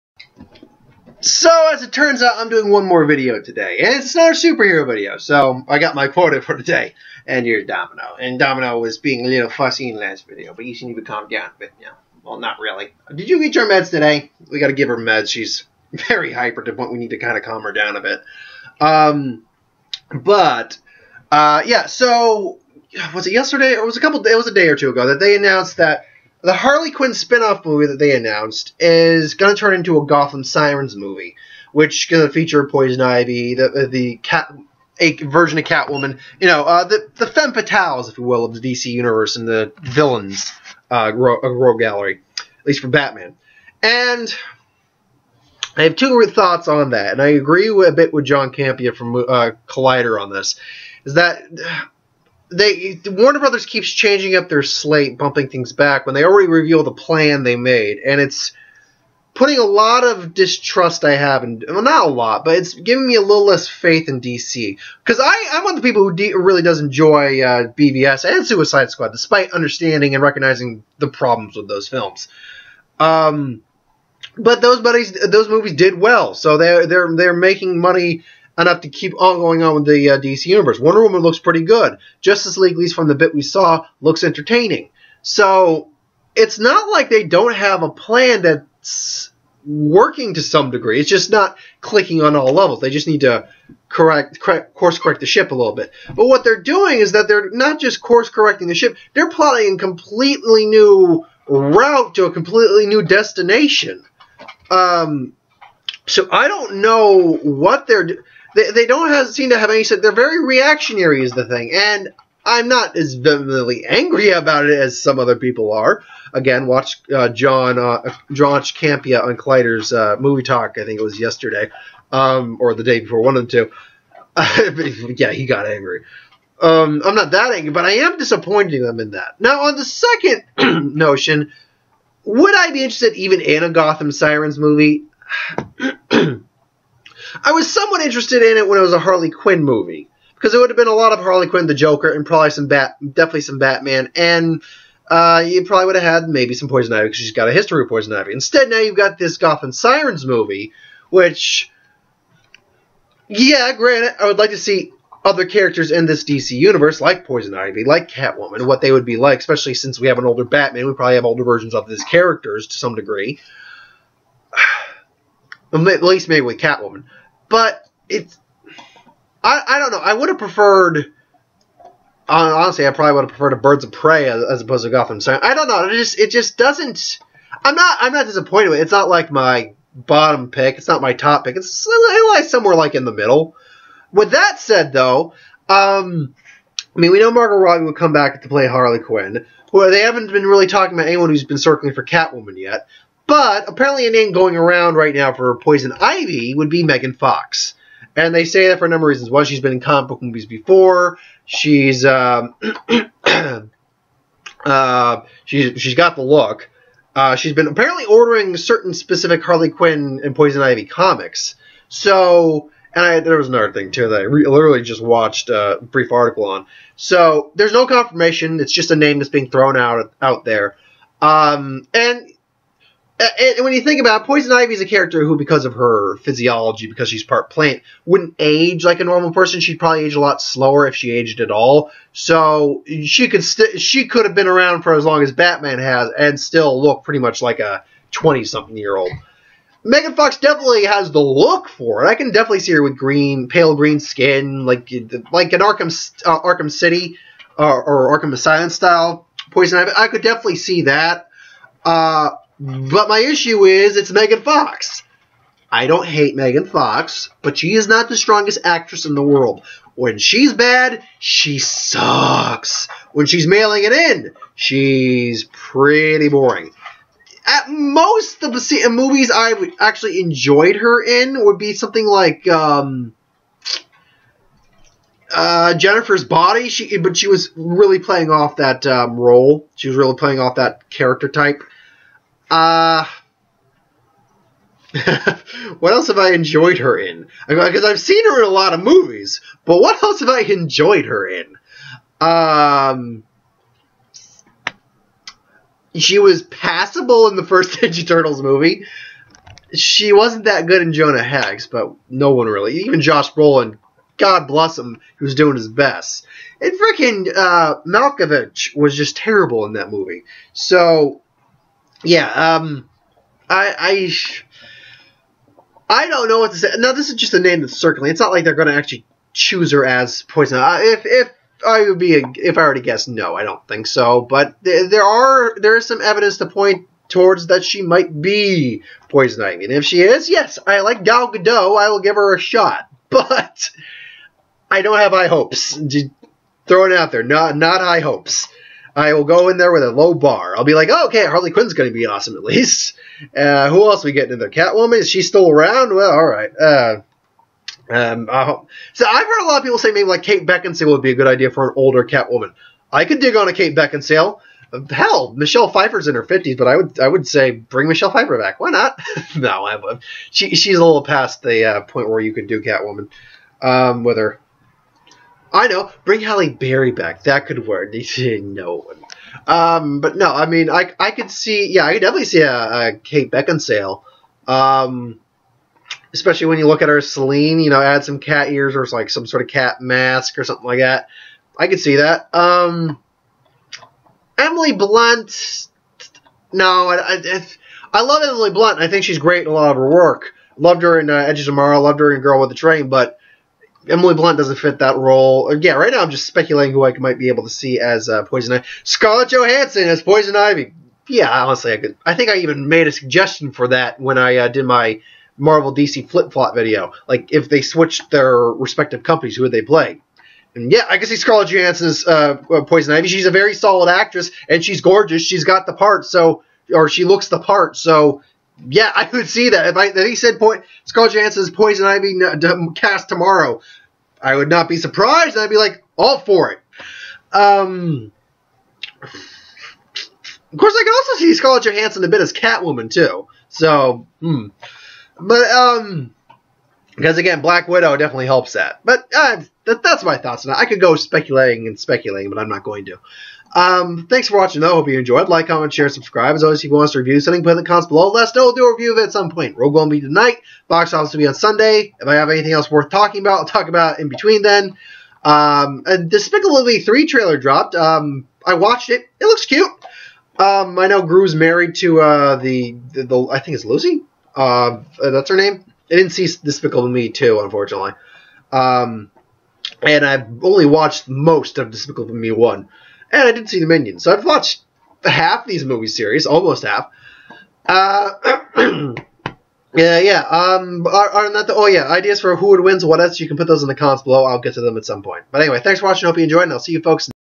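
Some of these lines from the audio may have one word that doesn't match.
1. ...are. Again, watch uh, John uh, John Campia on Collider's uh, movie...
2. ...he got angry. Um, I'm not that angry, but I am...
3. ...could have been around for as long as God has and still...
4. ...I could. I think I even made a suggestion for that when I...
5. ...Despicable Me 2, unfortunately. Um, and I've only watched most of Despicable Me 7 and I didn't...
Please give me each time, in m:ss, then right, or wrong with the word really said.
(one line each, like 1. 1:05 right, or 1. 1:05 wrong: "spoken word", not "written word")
1. 1:55 right
2. 2:05 right
3. 3:54 wrong: "Batman", not "God"
4. 6:41 right
5. 7:46 wrong: "1", not "7".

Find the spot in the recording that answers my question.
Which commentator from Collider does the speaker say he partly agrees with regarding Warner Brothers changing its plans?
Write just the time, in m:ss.
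0:48.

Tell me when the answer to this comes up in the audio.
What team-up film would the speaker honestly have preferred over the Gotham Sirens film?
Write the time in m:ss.
2:53.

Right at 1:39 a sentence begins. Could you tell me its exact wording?
They're plotting a completely new route to a completely new destination.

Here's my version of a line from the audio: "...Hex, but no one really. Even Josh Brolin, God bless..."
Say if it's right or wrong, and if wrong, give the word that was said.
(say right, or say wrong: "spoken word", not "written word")
right.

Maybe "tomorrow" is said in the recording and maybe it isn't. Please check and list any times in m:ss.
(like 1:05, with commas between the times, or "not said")
6:31, 7:03.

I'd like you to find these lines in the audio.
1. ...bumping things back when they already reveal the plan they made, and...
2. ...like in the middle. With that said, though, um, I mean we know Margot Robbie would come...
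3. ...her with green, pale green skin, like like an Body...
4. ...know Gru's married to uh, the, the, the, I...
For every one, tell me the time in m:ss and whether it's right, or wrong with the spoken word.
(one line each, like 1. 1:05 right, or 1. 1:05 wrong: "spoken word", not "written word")
1. 0:55 right
2. 3:02 right
3. 4:02 wrong: "Arkham", not "Body"
4. 7:40 right.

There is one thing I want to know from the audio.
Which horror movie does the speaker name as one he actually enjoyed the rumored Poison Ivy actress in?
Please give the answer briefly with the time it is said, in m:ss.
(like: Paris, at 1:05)
Jennifer's Body, at 4:35.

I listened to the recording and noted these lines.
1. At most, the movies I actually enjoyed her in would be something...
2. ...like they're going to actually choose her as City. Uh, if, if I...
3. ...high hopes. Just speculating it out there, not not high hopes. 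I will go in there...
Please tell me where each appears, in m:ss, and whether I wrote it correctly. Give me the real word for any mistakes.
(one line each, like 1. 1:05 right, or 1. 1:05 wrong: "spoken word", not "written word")
1. 4:27 right
2. 5:18 wrong: "Poison", not "City"
3. 5:35 wrong: "throwing", not "speculating".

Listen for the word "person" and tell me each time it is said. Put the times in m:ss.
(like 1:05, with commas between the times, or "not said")
3:49.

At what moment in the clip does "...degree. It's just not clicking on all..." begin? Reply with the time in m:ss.
1:30.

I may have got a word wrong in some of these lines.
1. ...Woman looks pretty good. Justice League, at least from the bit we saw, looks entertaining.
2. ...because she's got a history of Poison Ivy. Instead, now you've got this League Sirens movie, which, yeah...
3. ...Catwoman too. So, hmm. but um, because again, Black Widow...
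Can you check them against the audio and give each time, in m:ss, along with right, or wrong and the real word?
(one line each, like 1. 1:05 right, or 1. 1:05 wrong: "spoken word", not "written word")
1. 1:21 right
2. 2:27 wrong: "Gotham", not "League"
3. 7:12 right.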